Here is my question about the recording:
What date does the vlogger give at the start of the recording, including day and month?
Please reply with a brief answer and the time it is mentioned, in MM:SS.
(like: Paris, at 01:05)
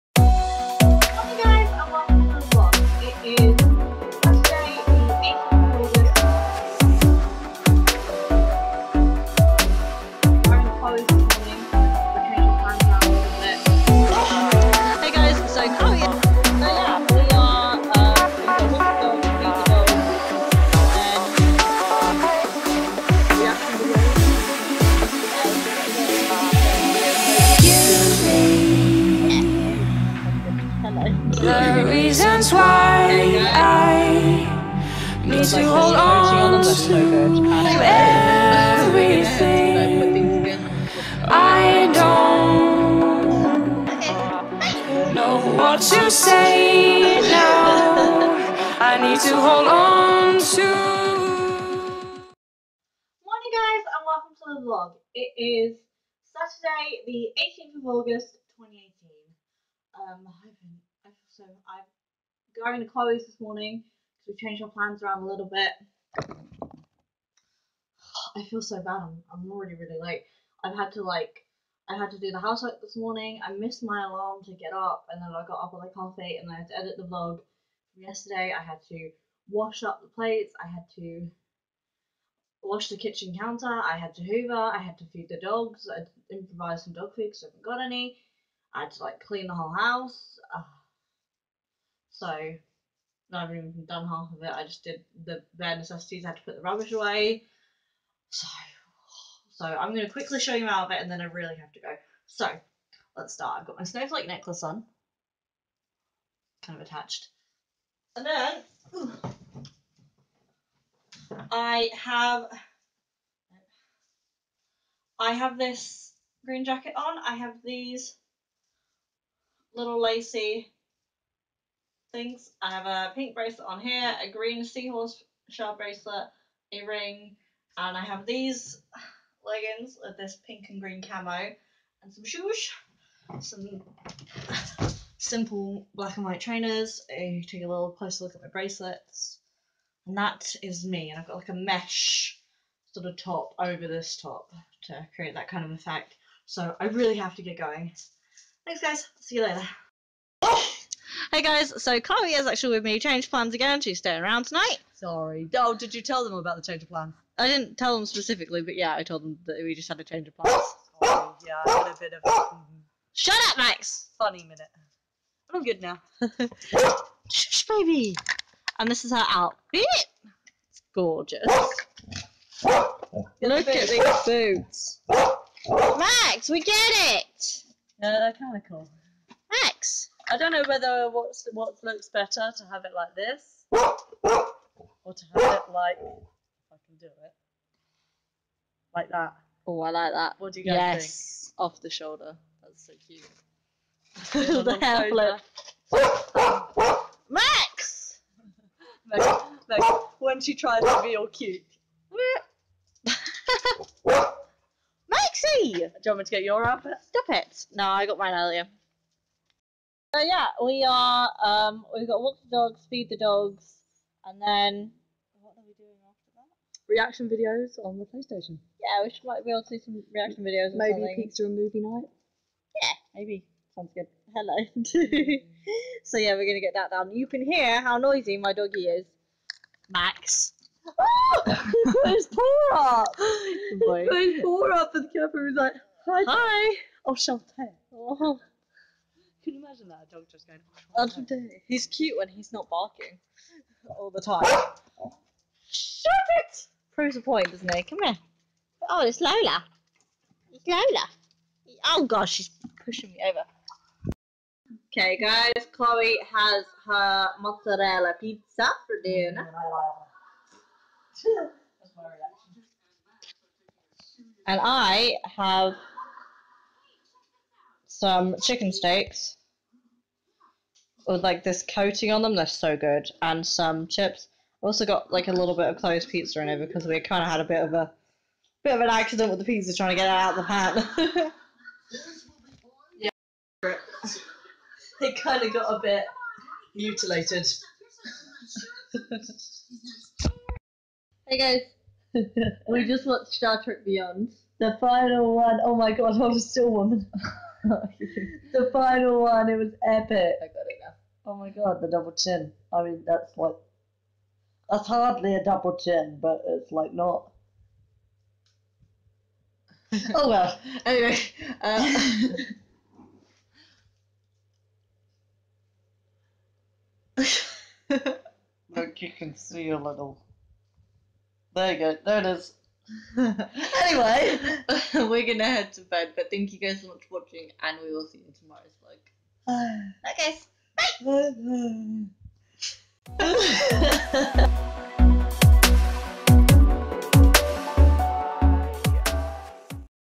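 18th of August, at 00:57.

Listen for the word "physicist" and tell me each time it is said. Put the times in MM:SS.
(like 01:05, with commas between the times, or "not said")
not said.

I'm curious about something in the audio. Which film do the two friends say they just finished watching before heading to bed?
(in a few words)
Star Trek Beyond.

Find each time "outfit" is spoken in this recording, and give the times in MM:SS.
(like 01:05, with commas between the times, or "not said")
02:49, 03:26.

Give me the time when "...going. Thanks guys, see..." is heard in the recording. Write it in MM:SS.
02:27.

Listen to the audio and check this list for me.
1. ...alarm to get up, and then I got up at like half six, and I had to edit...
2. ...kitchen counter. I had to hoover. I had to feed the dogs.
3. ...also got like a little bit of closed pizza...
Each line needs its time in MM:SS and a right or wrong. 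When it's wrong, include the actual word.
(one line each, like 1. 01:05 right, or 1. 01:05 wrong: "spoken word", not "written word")
1. 01:14 wrong: "eight", not "six"
2. 01:22 right
3. 04:34 right.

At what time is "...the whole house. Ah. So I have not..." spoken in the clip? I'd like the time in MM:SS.
01:29.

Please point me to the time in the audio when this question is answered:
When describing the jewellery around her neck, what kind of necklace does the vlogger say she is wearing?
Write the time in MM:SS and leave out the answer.
01:43.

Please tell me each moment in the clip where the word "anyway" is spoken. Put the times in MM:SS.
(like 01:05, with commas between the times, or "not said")
05:10, 05:23.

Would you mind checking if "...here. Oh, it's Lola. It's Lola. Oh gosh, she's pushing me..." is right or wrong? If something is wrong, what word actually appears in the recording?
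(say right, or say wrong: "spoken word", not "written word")
right.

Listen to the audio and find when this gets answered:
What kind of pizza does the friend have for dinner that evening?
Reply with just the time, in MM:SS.
04:17.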